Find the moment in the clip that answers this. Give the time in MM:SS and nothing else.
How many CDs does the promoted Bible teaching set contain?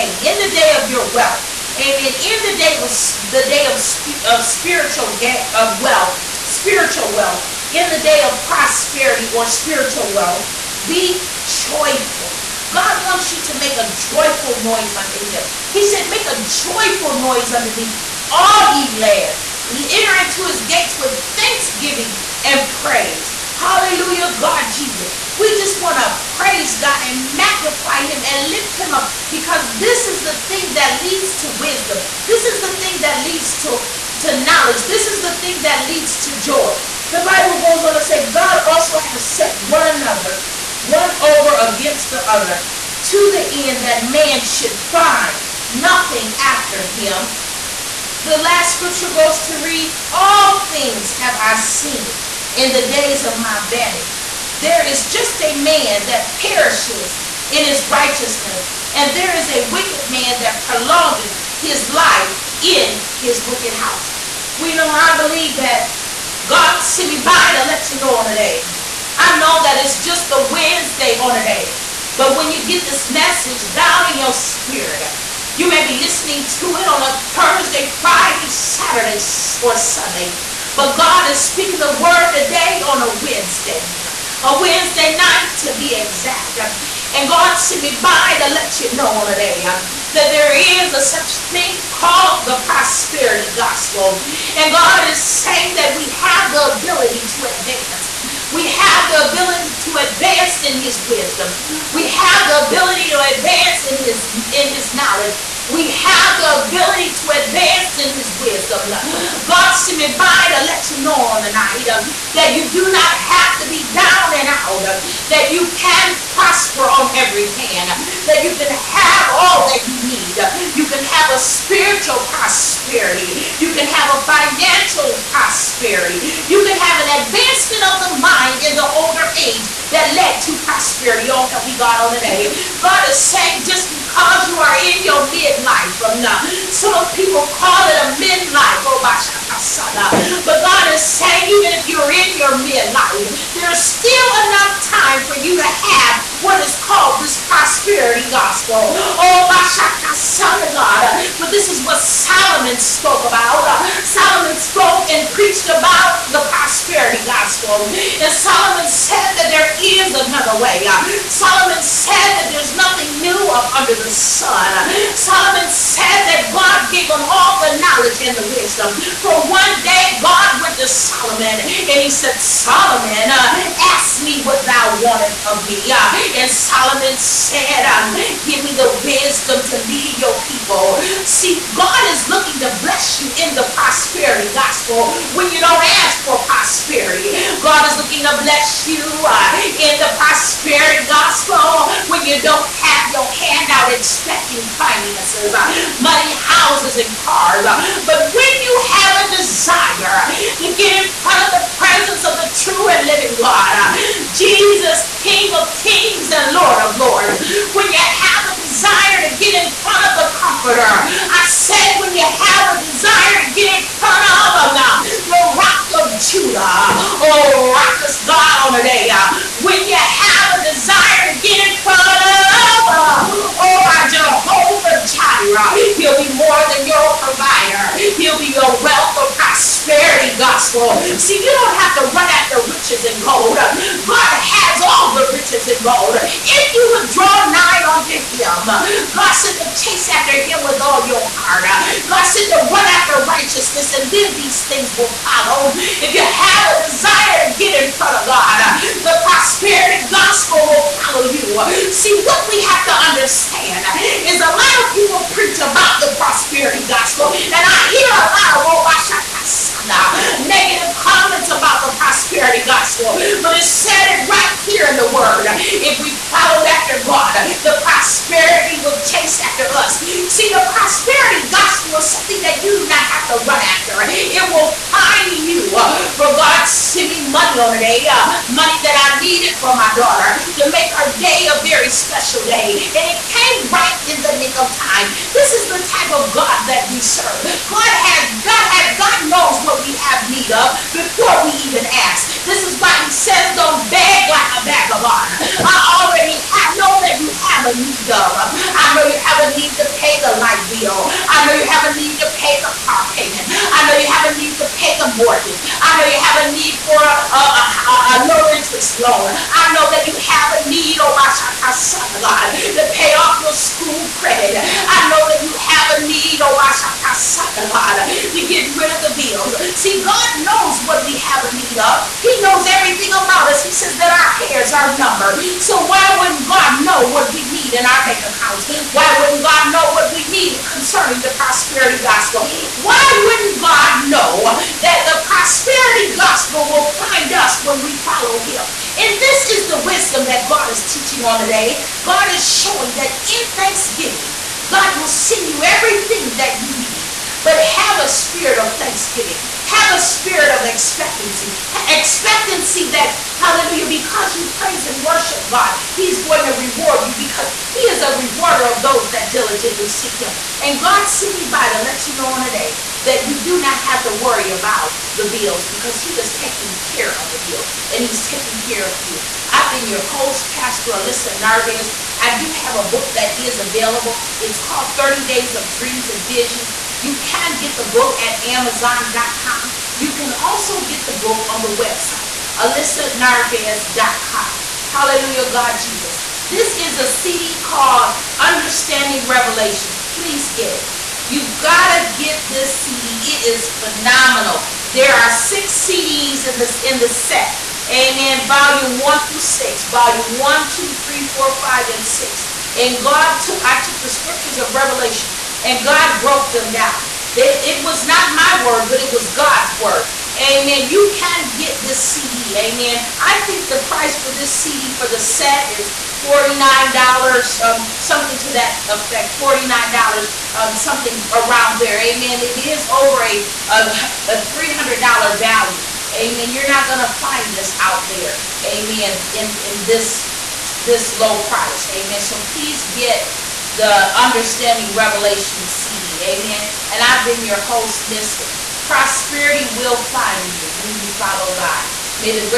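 06:35.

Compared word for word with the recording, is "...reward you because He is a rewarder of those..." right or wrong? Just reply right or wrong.
right.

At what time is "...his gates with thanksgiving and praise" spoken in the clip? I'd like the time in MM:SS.
00:20.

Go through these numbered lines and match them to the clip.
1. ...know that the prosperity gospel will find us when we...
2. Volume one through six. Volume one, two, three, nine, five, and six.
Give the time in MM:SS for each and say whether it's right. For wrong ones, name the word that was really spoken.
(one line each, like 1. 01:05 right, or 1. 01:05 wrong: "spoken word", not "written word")
1. 05:34 right
2. 06:38 wrong: "four", not "nine".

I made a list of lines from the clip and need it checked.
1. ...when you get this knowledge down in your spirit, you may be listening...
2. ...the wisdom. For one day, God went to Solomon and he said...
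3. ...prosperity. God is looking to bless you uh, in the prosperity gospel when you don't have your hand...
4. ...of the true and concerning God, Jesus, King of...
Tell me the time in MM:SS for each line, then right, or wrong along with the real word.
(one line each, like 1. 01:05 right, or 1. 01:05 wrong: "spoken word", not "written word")
1. 01:12 wrong: "message", not "knowledge"
2. 02:48 right
3. 03:06 right
4. 03:22 wrong: "living", not "concerning".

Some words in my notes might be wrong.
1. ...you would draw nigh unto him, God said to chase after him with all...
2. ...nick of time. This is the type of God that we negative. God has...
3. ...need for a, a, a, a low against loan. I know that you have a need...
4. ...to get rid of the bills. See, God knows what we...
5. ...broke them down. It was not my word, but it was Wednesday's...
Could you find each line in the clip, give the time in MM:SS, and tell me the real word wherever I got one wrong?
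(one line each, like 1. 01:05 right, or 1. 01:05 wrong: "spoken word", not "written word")
1. 03:56 right
2. 04:44 wrong: "serve", not "negative"
3. 05:06 wrong: "interest", not "against"
4. 05:18 right
5. 06:46 wrong: "God", not "Wednesday".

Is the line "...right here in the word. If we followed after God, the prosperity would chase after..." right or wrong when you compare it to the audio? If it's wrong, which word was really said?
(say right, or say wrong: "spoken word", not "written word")
right.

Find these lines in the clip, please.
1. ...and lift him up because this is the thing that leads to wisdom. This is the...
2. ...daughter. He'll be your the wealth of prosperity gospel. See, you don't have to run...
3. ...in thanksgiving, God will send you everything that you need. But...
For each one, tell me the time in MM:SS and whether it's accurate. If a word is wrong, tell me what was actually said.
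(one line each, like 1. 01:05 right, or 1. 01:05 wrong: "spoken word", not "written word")
1. 00:28 right
2. 03:47 wrong: "provider", not "daughter"
3. 05:43 right.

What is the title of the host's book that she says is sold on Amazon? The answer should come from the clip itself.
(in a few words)
30 Days of Dreams and Visions.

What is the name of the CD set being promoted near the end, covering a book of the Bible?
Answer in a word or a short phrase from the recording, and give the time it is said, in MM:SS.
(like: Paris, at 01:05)
Understanding Revelations, at 06:28.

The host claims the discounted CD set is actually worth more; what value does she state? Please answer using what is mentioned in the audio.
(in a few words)
$300.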